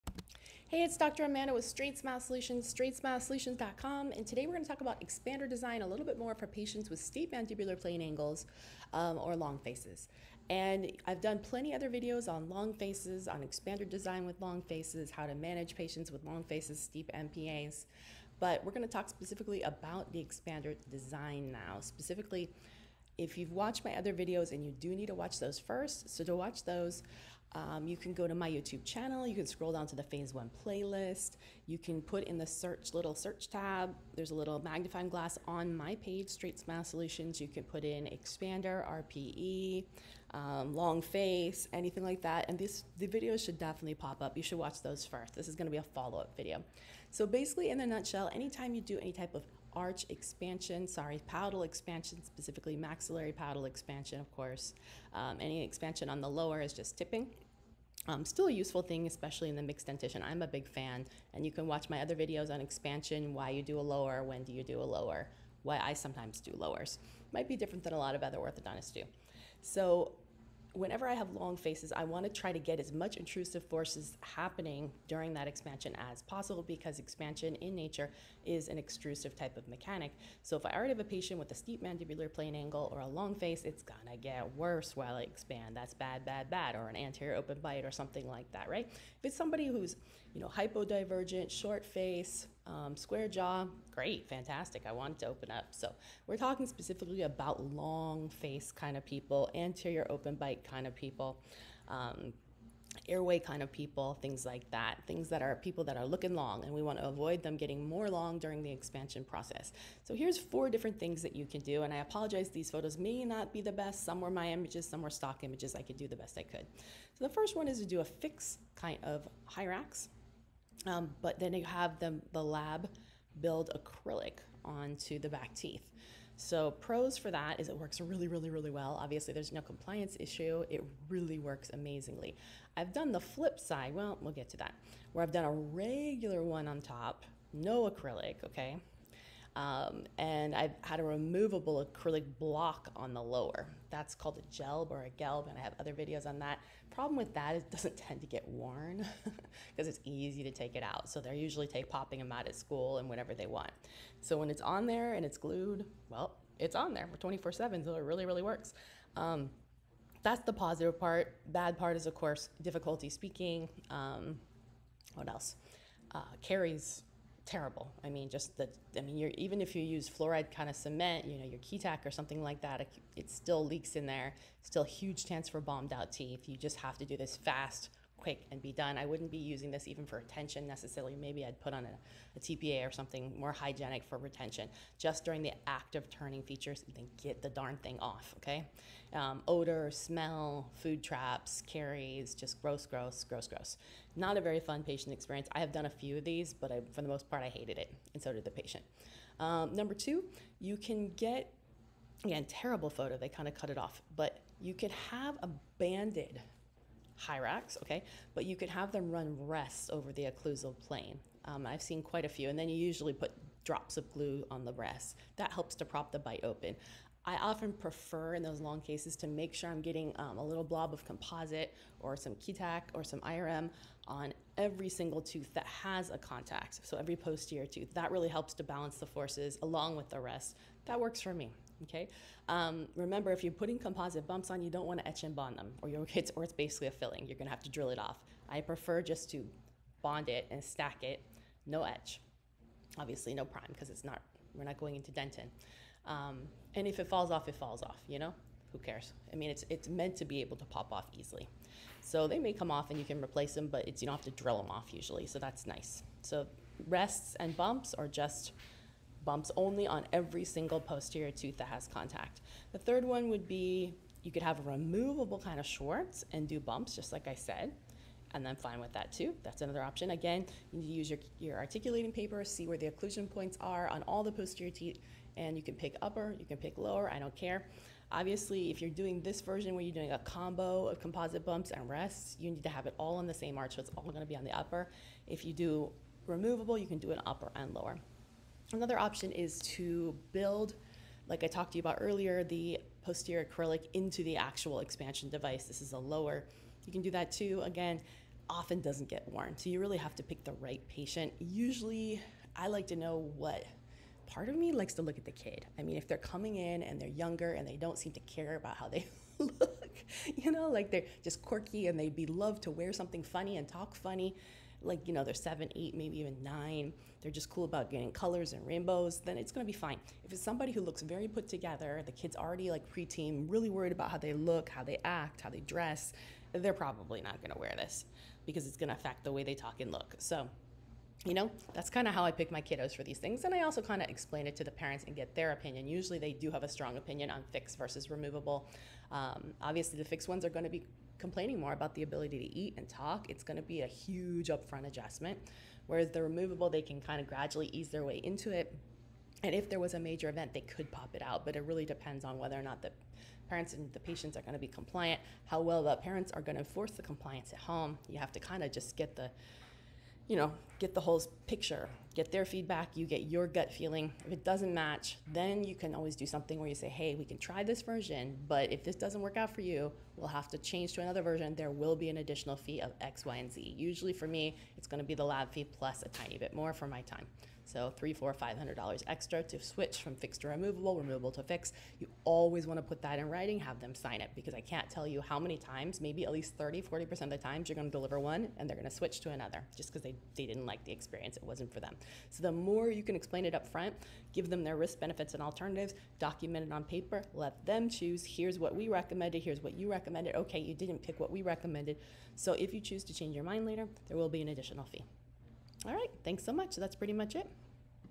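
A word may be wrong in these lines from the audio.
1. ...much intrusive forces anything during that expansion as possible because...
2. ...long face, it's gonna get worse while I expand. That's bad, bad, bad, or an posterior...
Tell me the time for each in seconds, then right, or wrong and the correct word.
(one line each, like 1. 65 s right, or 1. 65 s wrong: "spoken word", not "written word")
1. 72 s wrong: "happening", not "anything"
2. 83 s wrong: "anterior", not "posterior".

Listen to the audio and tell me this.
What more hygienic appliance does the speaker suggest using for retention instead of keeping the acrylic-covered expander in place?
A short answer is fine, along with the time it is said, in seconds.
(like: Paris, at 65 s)
TPA, at 182 s.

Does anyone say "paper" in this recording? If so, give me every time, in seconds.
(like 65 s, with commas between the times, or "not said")
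272 s, 396 s.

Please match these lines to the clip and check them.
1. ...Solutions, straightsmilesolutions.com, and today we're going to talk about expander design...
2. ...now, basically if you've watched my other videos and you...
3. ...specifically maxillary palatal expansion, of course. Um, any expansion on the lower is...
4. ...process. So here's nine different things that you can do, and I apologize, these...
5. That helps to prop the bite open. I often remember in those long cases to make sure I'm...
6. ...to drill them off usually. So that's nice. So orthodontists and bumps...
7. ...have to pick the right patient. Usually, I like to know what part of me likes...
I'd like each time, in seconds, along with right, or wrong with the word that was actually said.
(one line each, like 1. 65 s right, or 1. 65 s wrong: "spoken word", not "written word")
1. 2 s right
2. 21 s wrong: "specifically", not "basically"
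3. 52 s right
4. 109 s wrong: "four", not "nine"
5. 215 s wrong: "prefer", not "remember"
6. 254 s wrong: "rests", not "orthodontists"
7. 299 s right.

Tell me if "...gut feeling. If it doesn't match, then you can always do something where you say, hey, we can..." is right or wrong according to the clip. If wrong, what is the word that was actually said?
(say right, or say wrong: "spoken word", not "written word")
right.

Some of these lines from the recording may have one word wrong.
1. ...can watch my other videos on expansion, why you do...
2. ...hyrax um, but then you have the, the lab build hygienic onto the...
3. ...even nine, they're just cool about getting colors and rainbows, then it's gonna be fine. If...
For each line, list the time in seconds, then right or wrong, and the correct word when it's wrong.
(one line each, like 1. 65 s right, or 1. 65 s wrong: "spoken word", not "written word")
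1. 61 s right
2. 119 s wrong: "acrylic", not "hygienic"
3. 316 s right.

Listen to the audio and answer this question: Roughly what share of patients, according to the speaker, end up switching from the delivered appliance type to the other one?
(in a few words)
30 to 40%.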